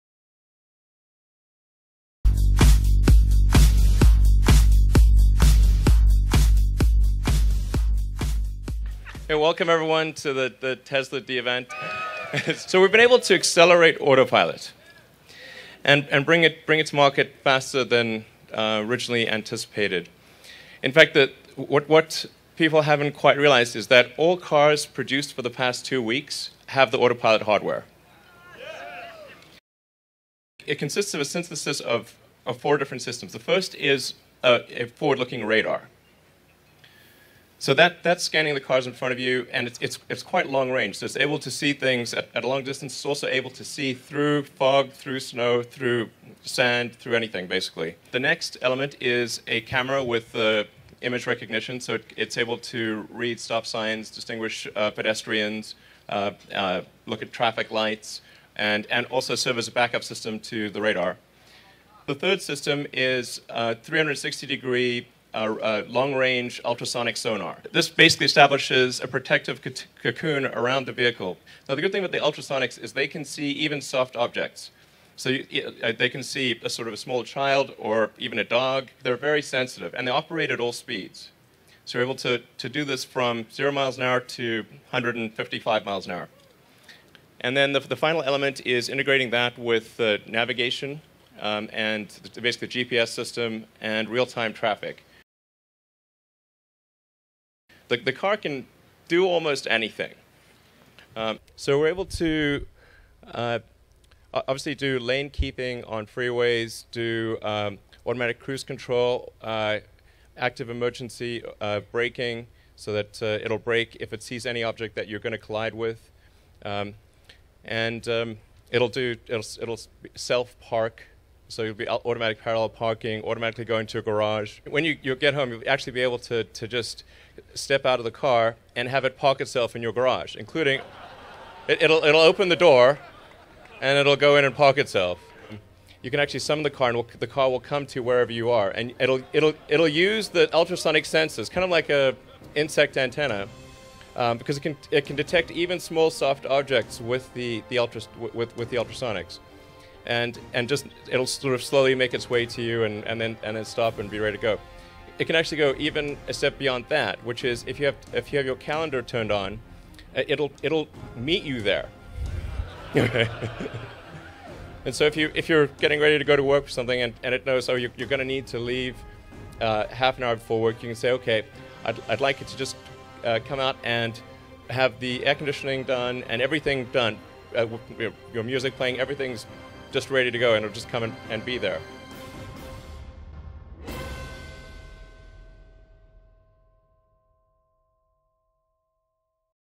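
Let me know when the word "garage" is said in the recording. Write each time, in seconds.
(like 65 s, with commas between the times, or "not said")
124 s, 129 s.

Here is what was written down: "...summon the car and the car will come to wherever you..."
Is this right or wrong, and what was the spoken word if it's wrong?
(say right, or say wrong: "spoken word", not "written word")
right.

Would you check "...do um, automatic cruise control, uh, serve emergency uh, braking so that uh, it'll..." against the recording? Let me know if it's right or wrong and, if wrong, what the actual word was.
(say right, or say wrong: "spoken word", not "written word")
wrong: "active", not "serve".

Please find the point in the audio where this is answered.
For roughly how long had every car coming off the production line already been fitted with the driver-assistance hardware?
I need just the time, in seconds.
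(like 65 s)
25 s.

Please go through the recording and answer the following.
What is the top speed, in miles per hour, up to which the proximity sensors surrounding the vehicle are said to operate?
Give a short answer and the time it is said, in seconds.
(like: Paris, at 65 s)
155, at 84 s.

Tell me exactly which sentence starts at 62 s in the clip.
The third system is uh, 360 degree a long-range ultrasonic sonar.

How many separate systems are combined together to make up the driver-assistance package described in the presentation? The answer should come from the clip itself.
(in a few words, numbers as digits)
4.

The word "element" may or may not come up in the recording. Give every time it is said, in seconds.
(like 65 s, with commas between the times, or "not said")
48 s, 88 s.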